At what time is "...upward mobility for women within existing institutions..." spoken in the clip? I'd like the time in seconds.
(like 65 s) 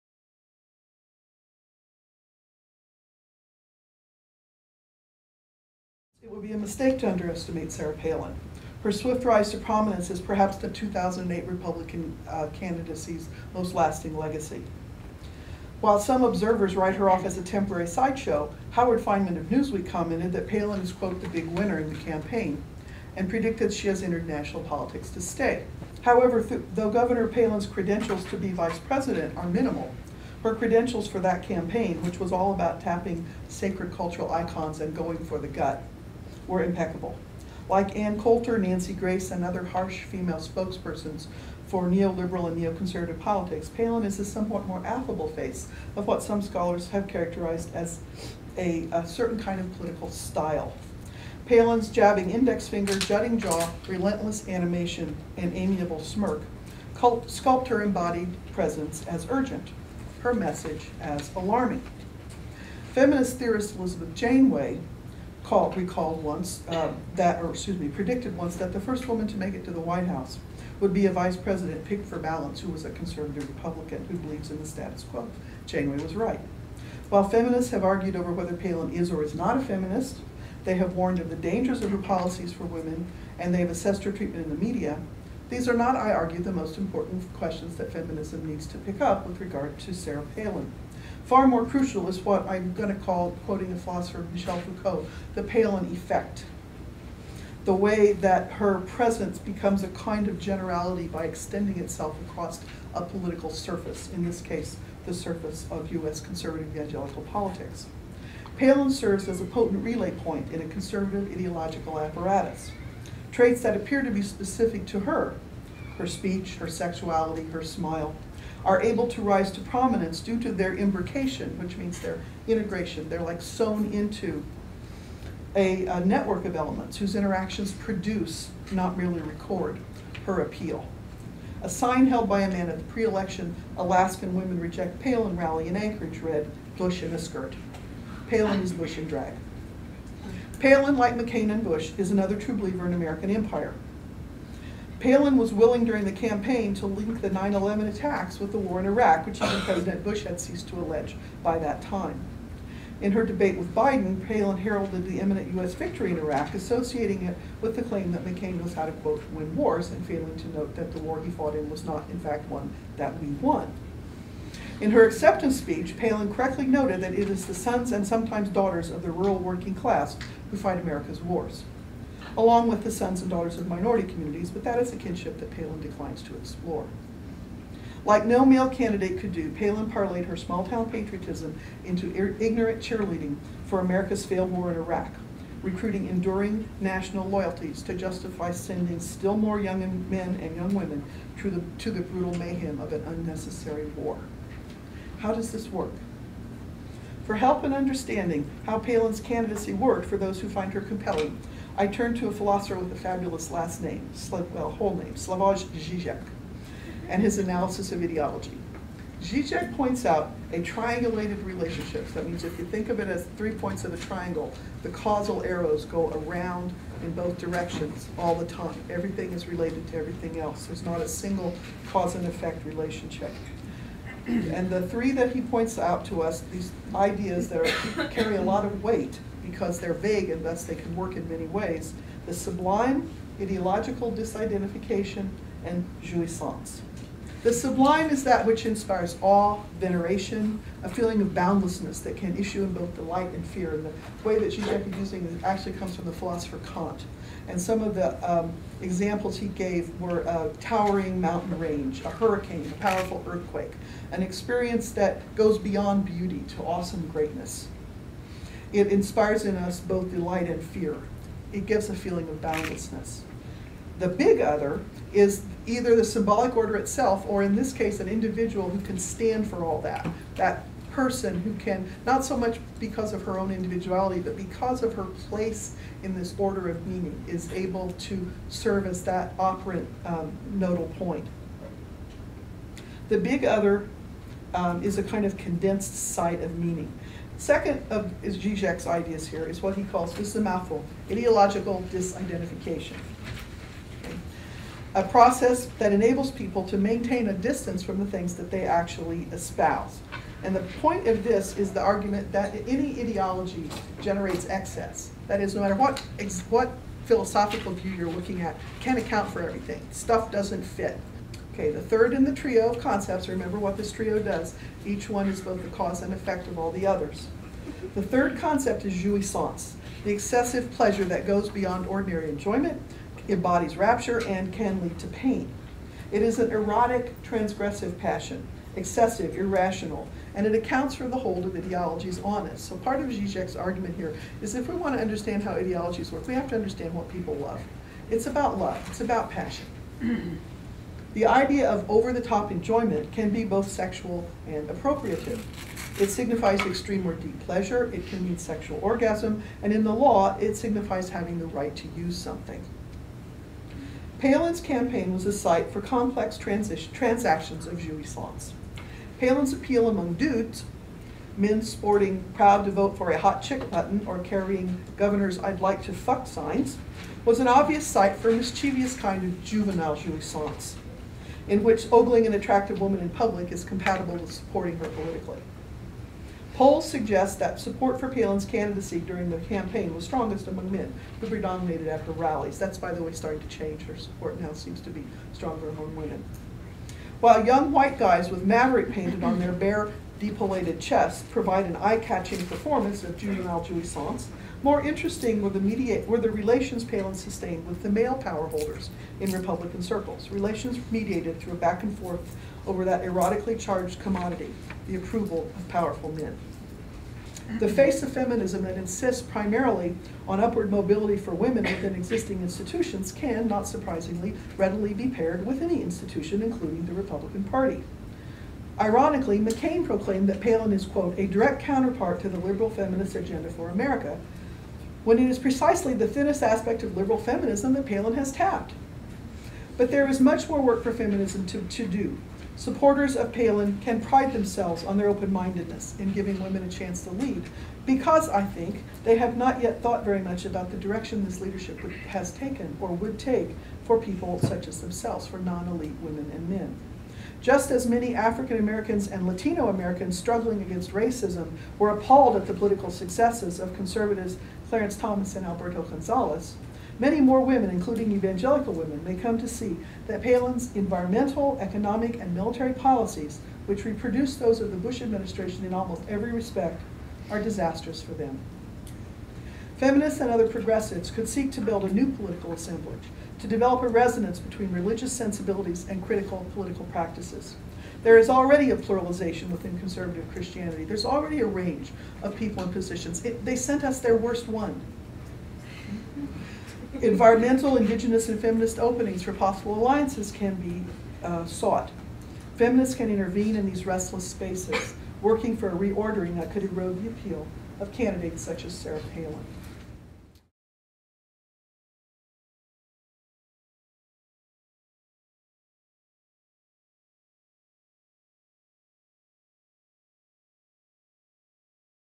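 410 s.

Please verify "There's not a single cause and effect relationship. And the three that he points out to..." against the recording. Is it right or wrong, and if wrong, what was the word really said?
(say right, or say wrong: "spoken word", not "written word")
right.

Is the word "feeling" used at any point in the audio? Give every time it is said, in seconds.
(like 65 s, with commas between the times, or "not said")
240 s, 261 s.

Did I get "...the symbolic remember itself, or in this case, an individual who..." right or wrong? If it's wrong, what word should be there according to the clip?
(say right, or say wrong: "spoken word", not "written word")
wrong: "order", not "remember".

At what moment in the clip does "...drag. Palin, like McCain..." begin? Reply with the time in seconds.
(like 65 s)
139 s.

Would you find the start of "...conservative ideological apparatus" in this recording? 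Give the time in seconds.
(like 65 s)
110 s.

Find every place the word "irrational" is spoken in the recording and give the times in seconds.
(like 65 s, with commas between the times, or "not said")
329 s.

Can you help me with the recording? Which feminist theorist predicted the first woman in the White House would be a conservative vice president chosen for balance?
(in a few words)
Elizabeth Janeway.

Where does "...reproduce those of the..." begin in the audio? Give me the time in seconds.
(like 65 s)
463 s.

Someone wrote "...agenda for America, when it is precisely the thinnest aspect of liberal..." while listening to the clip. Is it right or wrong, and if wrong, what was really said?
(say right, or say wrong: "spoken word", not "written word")
right.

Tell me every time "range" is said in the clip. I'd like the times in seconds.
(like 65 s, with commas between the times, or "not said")
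251 s, 481 s.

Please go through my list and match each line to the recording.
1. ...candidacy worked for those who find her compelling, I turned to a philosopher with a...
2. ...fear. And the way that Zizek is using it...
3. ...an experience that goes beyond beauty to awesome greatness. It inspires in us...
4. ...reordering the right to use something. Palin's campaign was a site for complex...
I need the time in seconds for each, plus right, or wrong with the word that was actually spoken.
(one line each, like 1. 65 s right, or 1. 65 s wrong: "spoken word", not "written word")
1. 199 s right
2. 243 s right
3. 254 s right
4. 351 s wrong: "having", not "reordering".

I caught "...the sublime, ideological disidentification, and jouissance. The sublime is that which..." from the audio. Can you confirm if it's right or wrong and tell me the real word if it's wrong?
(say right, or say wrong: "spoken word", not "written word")
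right.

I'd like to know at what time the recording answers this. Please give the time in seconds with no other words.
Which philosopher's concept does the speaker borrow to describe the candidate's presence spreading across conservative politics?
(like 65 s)
94 s.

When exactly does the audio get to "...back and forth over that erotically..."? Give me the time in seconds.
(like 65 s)
401 s.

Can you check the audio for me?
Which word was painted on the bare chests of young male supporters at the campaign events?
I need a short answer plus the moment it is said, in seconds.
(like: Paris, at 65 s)
maverick, at 388 s.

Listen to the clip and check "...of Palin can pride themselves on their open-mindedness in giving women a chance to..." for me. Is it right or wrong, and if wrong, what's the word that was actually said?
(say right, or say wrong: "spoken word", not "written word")
right.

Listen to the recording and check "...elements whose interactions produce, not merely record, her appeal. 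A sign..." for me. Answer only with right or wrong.
right.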